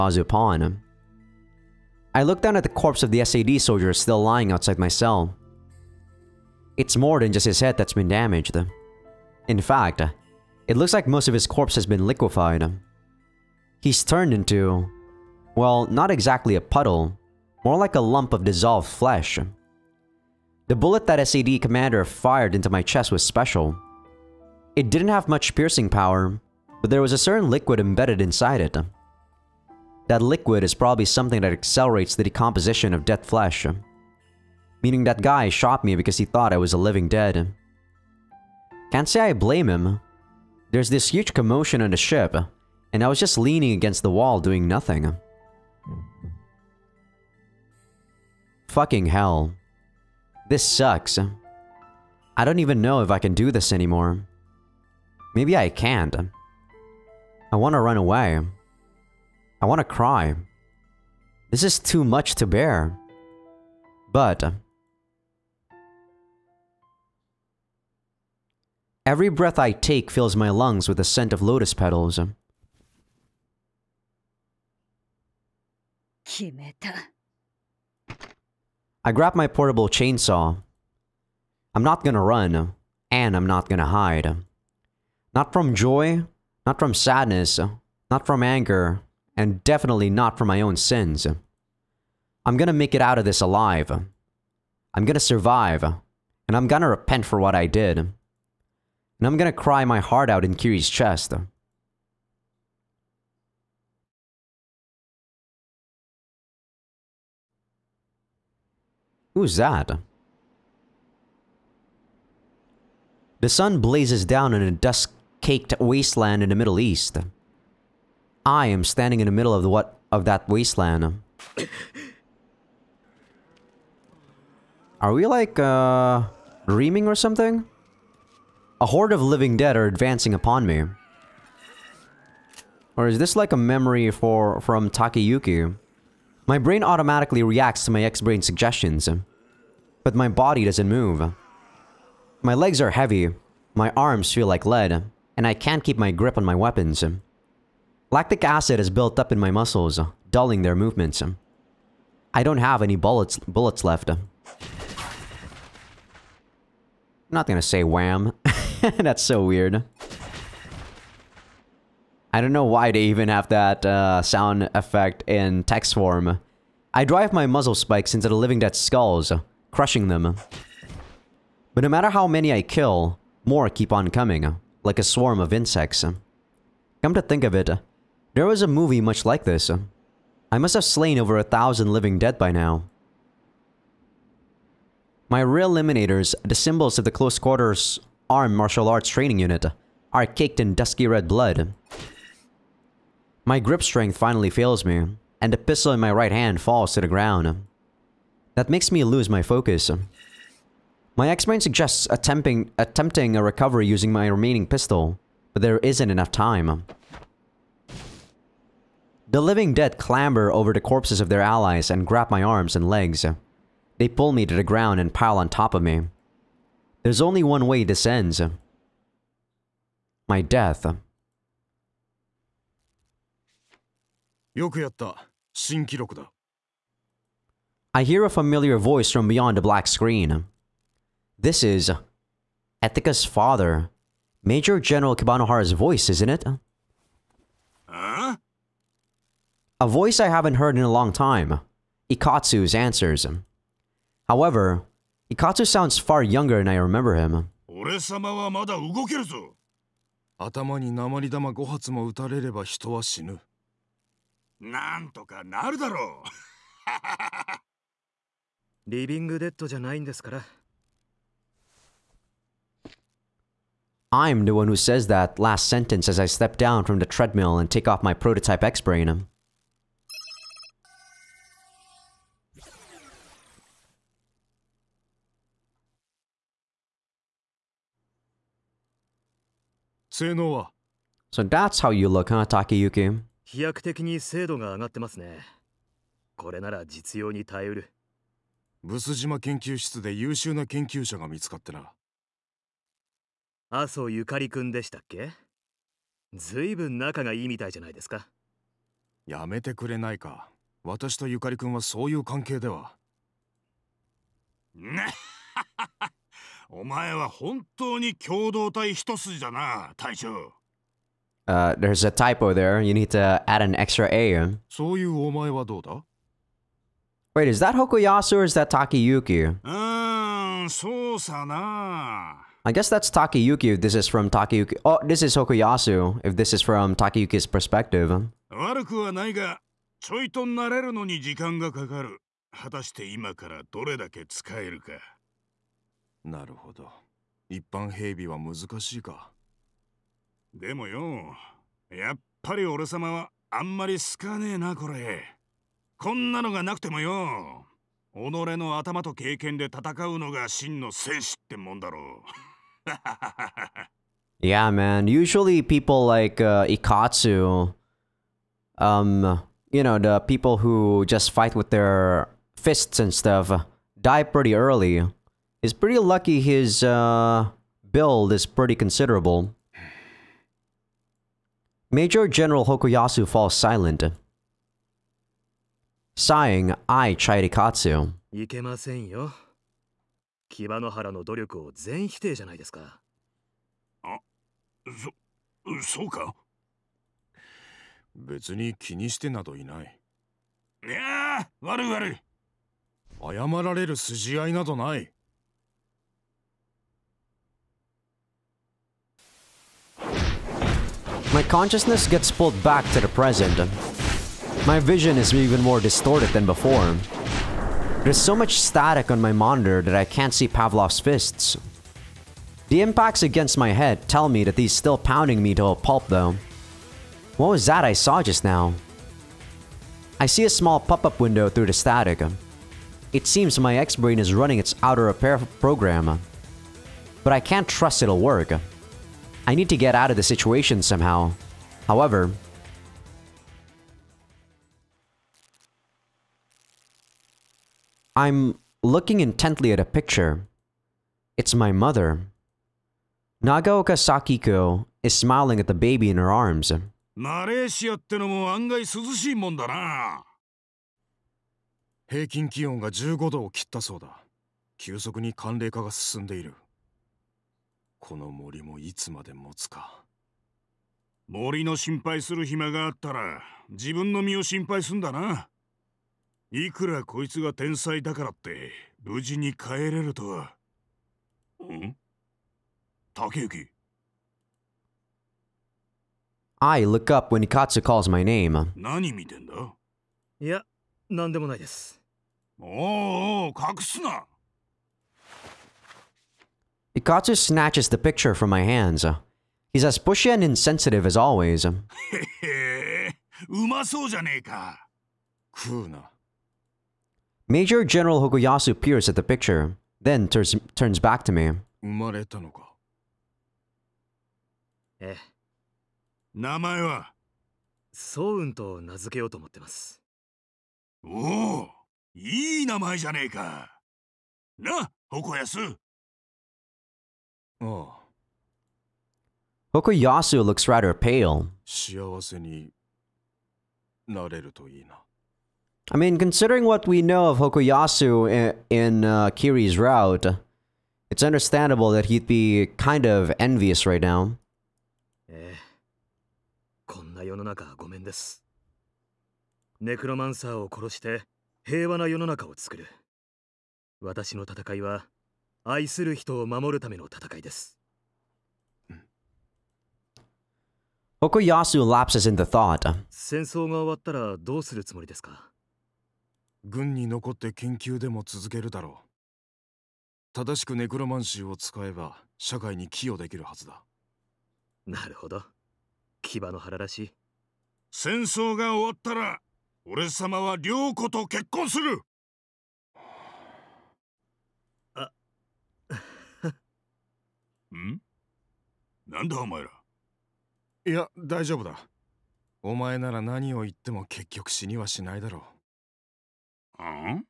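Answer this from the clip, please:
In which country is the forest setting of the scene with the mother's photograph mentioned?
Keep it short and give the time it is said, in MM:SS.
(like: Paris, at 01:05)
Malaysia, at 07:27.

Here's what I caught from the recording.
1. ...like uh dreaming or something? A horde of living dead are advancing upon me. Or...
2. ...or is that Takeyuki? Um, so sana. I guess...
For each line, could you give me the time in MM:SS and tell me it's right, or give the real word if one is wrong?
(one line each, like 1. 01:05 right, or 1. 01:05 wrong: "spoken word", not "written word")
1. 02:05 right
2. 05:18 right.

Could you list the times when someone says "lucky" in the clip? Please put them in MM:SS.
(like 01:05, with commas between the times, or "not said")
06:05.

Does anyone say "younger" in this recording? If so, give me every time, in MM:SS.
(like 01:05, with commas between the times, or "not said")
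04:06.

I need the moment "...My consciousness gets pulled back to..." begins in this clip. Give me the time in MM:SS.
06:41.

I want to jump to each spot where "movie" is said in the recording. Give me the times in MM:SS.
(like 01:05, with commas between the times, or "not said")
02:58.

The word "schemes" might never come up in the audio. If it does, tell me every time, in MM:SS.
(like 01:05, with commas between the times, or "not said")
not said.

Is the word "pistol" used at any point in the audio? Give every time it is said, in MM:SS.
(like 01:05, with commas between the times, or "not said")
03:15, 03:24.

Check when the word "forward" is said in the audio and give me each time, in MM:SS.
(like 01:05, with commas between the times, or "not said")
not said.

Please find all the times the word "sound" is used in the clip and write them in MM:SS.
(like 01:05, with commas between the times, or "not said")
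02:44, 04:05.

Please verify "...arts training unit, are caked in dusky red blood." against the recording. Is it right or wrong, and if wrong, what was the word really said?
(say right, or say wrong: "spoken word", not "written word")
right.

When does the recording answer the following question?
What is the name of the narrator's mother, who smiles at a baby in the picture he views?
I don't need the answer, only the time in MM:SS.
07:23.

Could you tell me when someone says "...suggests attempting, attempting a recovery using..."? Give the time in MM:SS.
03:21.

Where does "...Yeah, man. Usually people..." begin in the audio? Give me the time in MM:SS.
05:54.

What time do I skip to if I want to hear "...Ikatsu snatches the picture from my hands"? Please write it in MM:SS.
08:06.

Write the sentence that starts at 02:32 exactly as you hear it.
I don't have any bullets bullets left.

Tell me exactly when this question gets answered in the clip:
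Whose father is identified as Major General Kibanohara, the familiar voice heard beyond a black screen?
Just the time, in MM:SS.
03:52.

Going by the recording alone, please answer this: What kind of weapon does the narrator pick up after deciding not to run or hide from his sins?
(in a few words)
portable chainsaw.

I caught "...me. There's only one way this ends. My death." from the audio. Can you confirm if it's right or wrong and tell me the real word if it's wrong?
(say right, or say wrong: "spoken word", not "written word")
right.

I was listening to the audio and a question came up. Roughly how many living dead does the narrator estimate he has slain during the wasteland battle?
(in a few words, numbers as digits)
over 1000.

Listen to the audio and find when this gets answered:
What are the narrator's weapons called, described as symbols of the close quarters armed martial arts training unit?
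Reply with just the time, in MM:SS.
03:05.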